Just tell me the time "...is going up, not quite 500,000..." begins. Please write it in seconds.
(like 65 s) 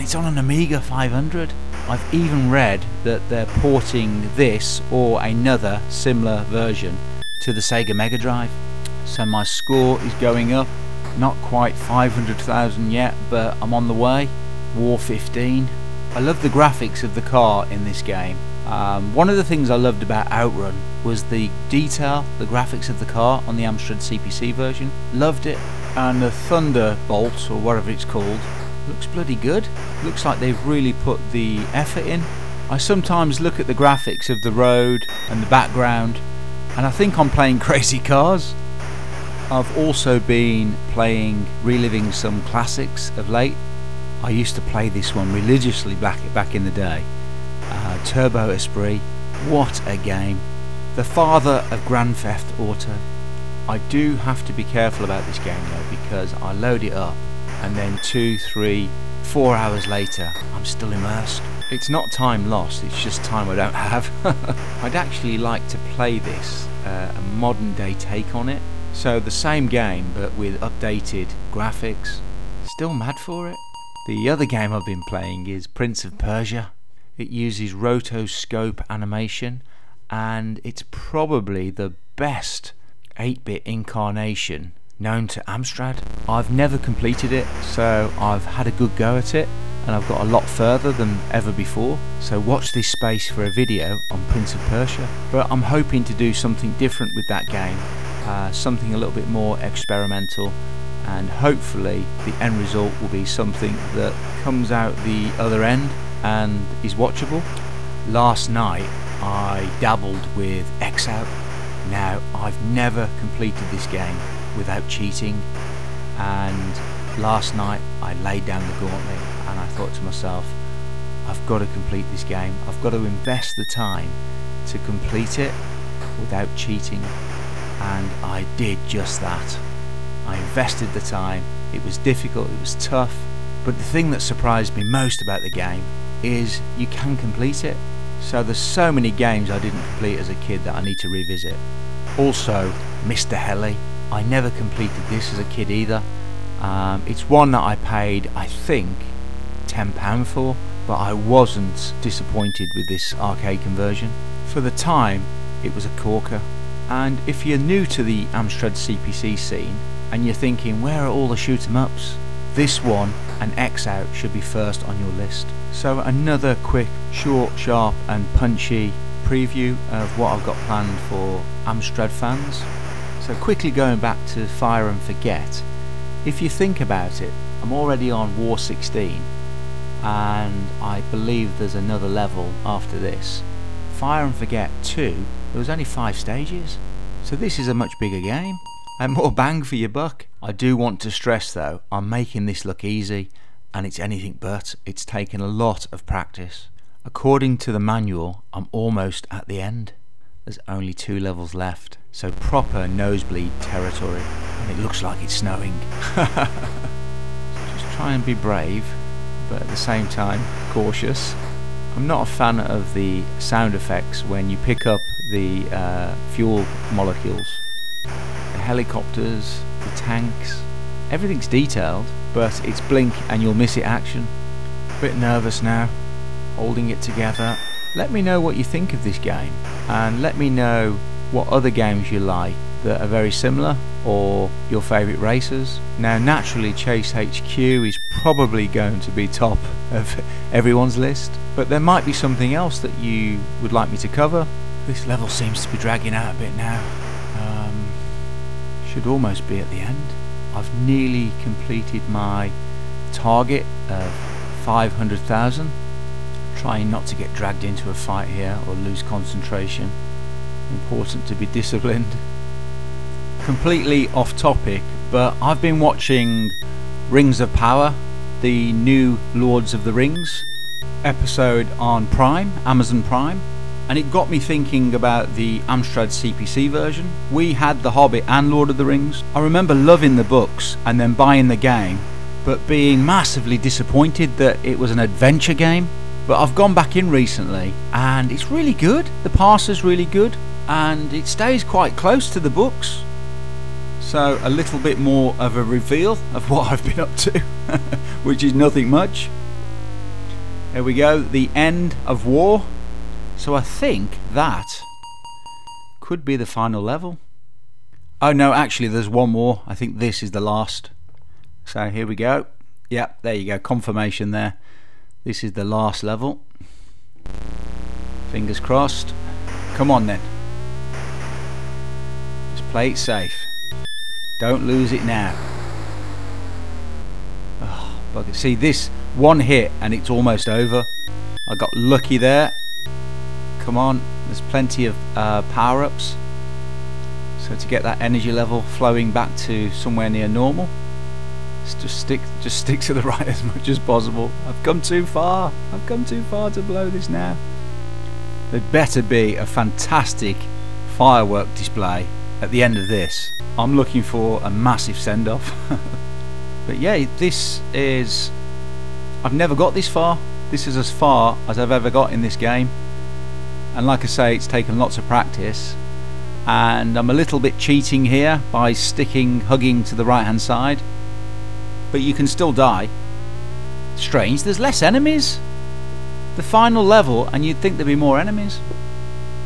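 10 s.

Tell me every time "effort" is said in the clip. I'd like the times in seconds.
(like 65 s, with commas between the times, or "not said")
31 s.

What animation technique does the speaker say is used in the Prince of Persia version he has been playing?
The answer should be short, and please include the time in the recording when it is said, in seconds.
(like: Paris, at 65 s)
rotoscope animation, at 77 s.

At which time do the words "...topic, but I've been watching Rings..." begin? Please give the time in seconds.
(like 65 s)
264 s.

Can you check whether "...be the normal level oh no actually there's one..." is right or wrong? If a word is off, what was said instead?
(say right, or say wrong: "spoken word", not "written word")
wrong: "final", not "normal".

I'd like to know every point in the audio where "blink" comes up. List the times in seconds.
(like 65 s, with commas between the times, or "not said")
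222 s.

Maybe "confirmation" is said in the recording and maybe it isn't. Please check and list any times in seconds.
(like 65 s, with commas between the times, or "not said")
313 s.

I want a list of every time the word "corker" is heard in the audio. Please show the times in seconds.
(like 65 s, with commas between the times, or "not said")
155 s.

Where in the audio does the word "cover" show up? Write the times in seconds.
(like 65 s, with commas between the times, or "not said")
244 s.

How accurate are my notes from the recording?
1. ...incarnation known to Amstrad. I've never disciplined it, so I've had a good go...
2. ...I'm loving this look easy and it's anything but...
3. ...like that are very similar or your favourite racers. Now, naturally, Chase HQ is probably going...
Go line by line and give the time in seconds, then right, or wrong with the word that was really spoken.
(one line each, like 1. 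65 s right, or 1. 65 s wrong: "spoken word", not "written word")
1. 83 s wrong: "completed", not "disciplined"
2. 191 s wrong: "making", not "loving"
3. 232 s right.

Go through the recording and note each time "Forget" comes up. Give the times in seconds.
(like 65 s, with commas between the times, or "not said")
175 s, 184 s.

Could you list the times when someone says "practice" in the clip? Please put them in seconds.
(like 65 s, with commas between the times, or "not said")
196 s, 365 s.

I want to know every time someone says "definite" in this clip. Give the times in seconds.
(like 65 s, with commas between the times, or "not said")
not said.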